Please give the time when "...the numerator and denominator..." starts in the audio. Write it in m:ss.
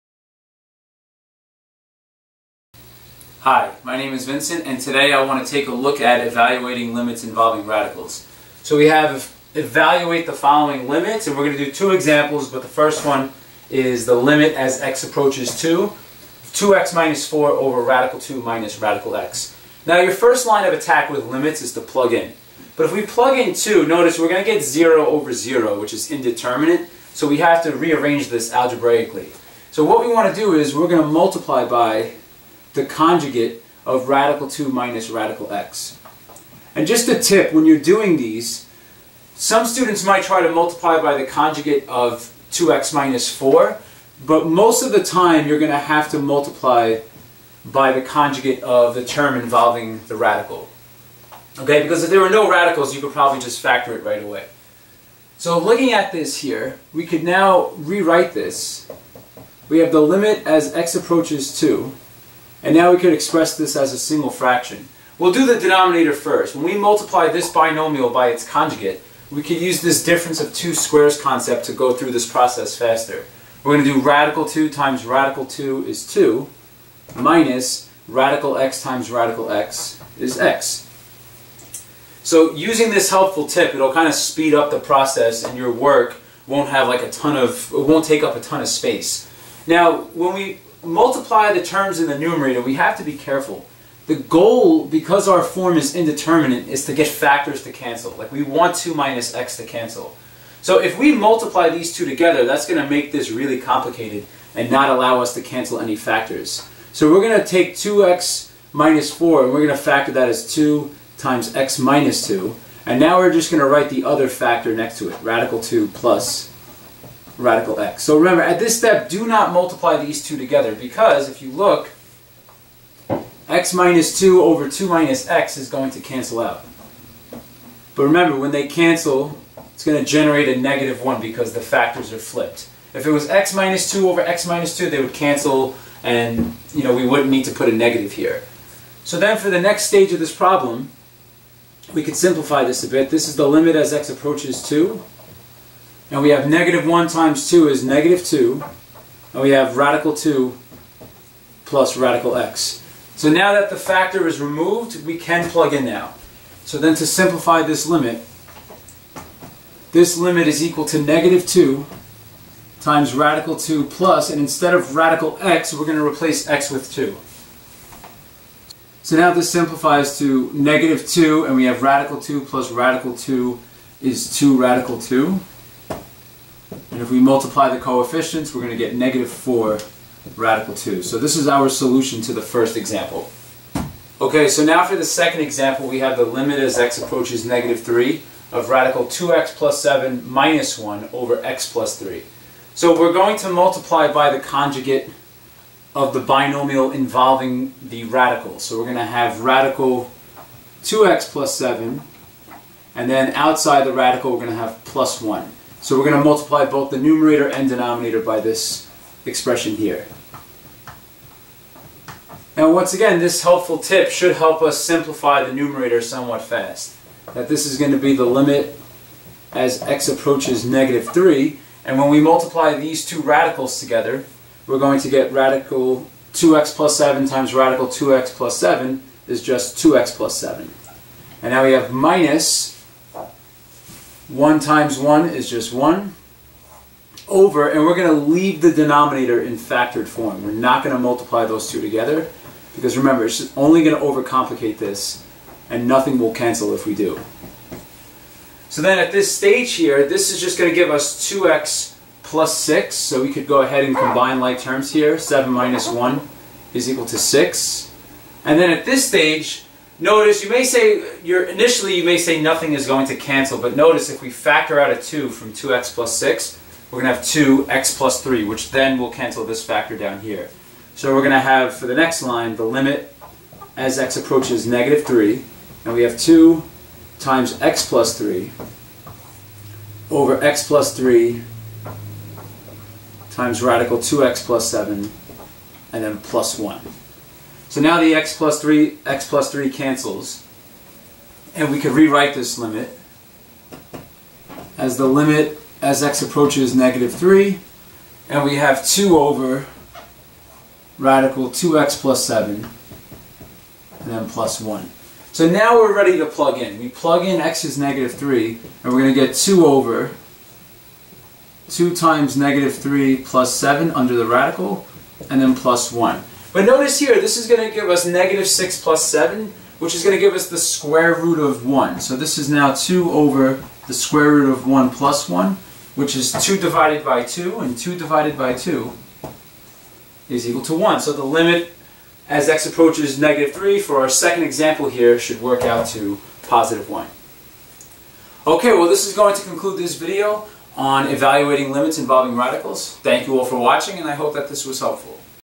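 3:26.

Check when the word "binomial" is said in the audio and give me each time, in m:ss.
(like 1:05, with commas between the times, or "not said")
1:07, 3:16.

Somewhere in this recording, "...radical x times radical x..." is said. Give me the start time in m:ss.
1:18.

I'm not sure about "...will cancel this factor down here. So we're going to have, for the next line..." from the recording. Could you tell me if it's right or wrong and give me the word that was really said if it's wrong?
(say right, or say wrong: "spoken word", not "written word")
right.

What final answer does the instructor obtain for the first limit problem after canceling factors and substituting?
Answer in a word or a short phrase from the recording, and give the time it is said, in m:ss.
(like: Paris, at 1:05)
-4 radical 2, at 2:58.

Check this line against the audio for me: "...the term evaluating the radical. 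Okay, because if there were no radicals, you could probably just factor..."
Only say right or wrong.
wrong.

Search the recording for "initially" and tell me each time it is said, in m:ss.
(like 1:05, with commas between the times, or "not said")
4:21.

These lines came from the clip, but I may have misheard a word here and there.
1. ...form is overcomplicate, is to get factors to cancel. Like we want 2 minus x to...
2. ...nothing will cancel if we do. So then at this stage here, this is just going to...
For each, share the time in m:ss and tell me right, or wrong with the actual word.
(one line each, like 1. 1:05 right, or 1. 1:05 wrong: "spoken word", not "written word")
1. 1:35 wrong: "indeterminate", not "overcomplicate"
2. 4:05 right.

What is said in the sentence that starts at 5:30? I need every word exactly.
So the limit as x approaches negative 3 for our second example here should work out to positive 1.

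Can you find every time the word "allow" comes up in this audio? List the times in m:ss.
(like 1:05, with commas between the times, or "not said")
1:44.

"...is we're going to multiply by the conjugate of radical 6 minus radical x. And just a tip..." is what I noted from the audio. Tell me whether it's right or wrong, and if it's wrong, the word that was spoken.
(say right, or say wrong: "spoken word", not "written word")
wrong: "2", not "6".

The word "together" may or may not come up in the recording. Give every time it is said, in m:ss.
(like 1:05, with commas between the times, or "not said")
1:42, 2:00, 3:43, 4:01.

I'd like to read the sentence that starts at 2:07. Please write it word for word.
But remember, when they cancel, it's going to generate a negative 1 because the factors are flipped.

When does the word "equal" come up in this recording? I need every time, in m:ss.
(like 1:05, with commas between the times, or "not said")
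2:40, 4:16, 5:30.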